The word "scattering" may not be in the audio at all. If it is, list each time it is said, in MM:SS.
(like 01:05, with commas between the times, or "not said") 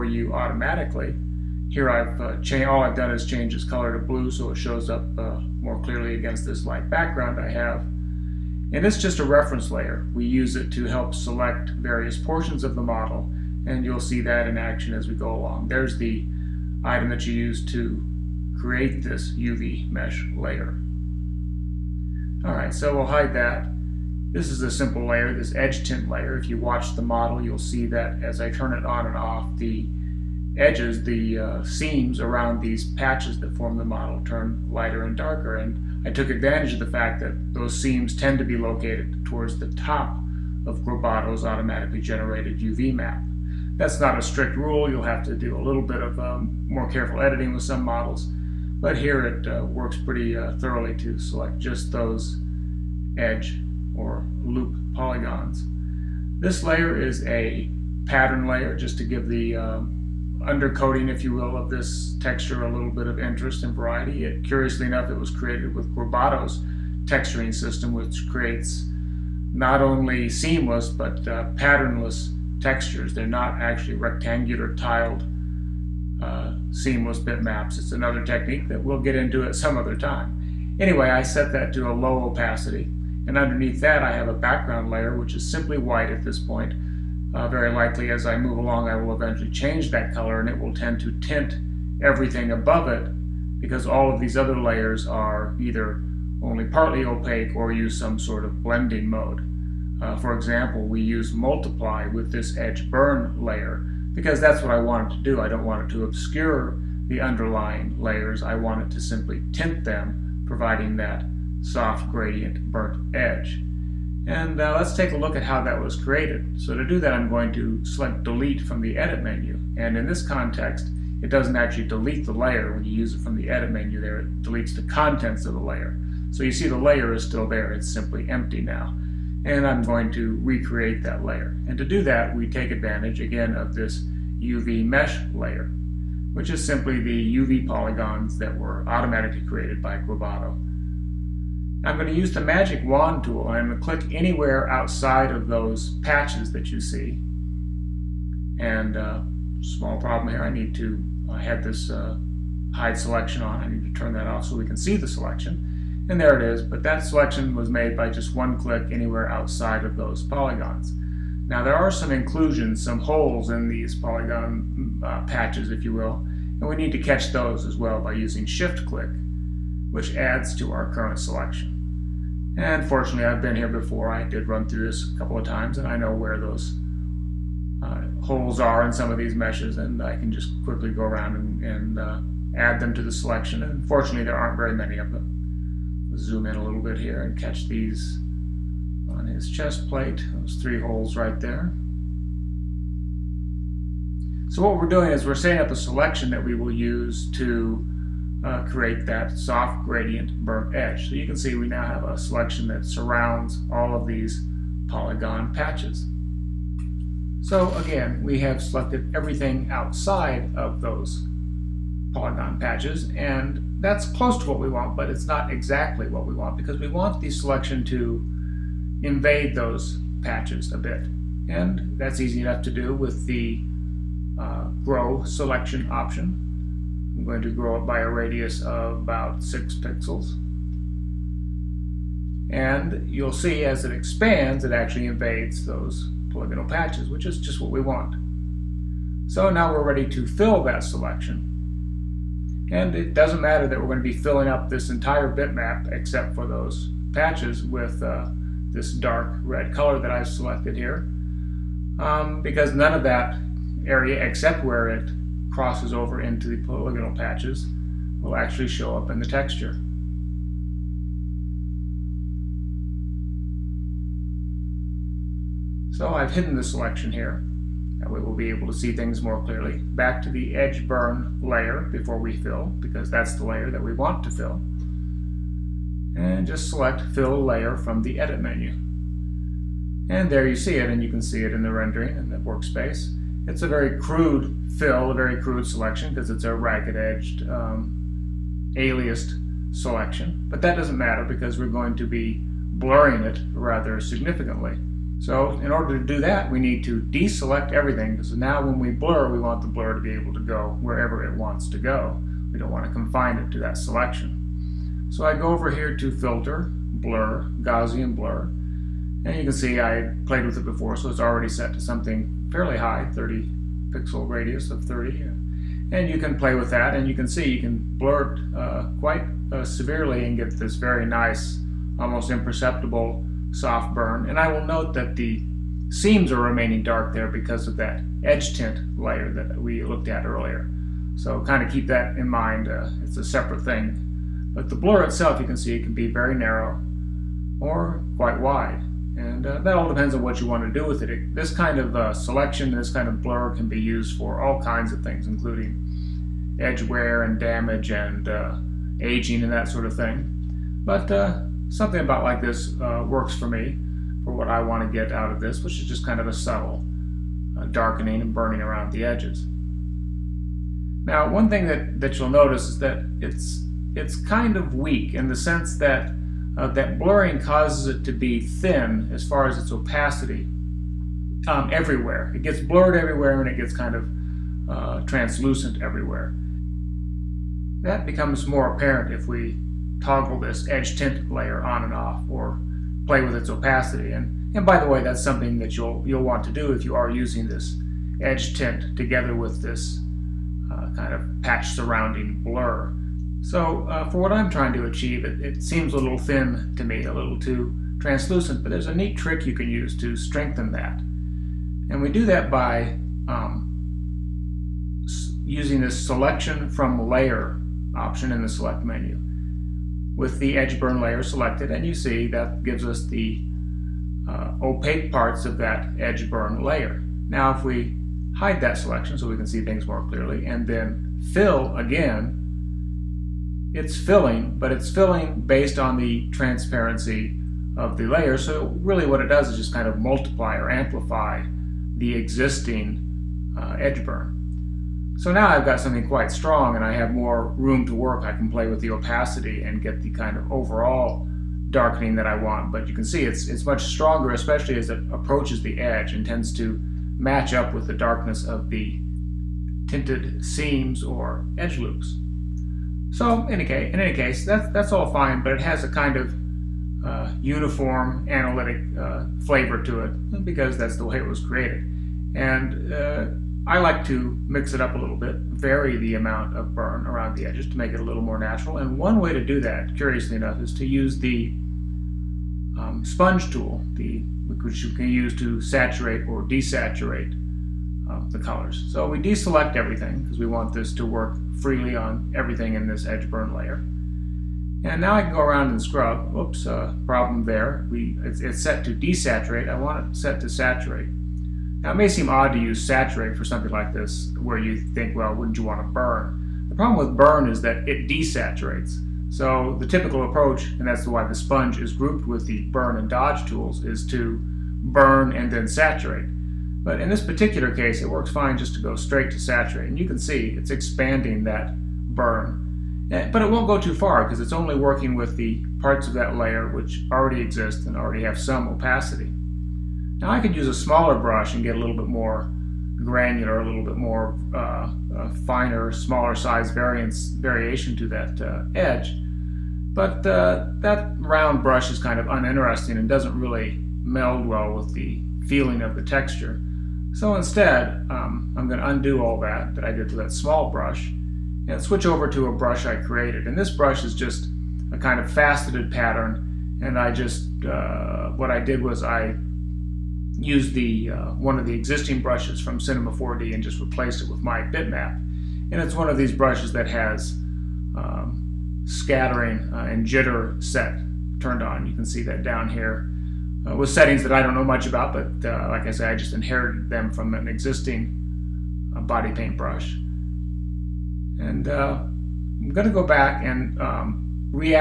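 09:18.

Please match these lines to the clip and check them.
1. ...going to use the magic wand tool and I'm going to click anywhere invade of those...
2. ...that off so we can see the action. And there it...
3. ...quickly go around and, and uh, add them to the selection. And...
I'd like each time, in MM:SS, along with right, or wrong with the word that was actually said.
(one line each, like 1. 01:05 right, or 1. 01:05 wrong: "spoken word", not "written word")
1. 02:21 wrong: "outside", not "invade"
2. 02:34 wrong: "selection", not "action"
3. 03:00 right.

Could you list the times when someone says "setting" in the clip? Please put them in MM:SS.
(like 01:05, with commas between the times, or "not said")
03:15, 09:23.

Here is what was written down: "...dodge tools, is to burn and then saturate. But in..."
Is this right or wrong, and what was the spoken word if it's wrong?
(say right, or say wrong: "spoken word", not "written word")
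right.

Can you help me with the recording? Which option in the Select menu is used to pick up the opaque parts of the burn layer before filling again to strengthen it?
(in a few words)
selection from layer.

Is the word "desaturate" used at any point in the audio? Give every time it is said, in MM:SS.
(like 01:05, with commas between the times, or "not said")
07:56, 08:08, 08:18.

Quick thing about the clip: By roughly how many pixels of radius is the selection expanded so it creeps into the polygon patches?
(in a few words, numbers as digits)
6.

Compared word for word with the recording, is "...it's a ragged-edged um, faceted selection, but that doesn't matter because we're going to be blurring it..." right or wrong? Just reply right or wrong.
wrong.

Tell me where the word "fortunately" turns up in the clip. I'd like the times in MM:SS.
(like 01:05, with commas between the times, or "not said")
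02:52, 03:03.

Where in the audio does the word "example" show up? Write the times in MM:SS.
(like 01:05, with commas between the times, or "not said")
01:40.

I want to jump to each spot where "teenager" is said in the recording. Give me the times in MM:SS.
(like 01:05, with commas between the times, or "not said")
not said.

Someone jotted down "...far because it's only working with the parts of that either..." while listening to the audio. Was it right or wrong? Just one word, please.
wrong.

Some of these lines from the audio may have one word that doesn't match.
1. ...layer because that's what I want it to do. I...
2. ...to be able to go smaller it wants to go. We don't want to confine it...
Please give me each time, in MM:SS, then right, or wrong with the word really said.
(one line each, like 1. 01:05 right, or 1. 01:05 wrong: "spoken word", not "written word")
1. 01:43 right
2. 04:59 wrong: "wherever", not "smaller".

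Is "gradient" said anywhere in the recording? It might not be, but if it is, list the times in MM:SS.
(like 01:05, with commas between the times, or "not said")
01:52, 03:19.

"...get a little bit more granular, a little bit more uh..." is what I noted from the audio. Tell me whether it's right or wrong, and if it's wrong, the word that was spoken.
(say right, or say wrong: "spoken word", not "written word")
right.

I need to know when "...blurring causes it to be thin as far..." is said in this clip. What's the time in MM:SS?
06:06.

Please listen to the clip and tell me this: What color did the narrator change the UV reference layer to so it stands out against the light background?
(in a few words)
blue.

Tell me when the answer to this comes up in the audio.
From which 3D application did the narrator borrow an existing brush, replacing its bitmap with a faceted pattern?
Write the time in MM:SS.
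09:12.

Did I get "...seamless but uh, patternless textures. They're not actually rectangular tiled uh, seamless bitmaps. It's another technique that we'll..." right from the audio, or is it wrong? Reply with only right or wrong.
right.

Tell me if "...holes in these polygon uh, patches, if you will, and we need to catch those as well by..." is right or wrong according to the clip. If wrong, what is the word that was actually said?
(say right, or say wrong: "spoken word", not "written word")
right.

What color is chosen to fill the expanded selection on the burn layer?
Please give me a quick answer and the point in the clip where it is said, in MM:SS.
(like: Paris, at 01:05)
dark red, at 04:08.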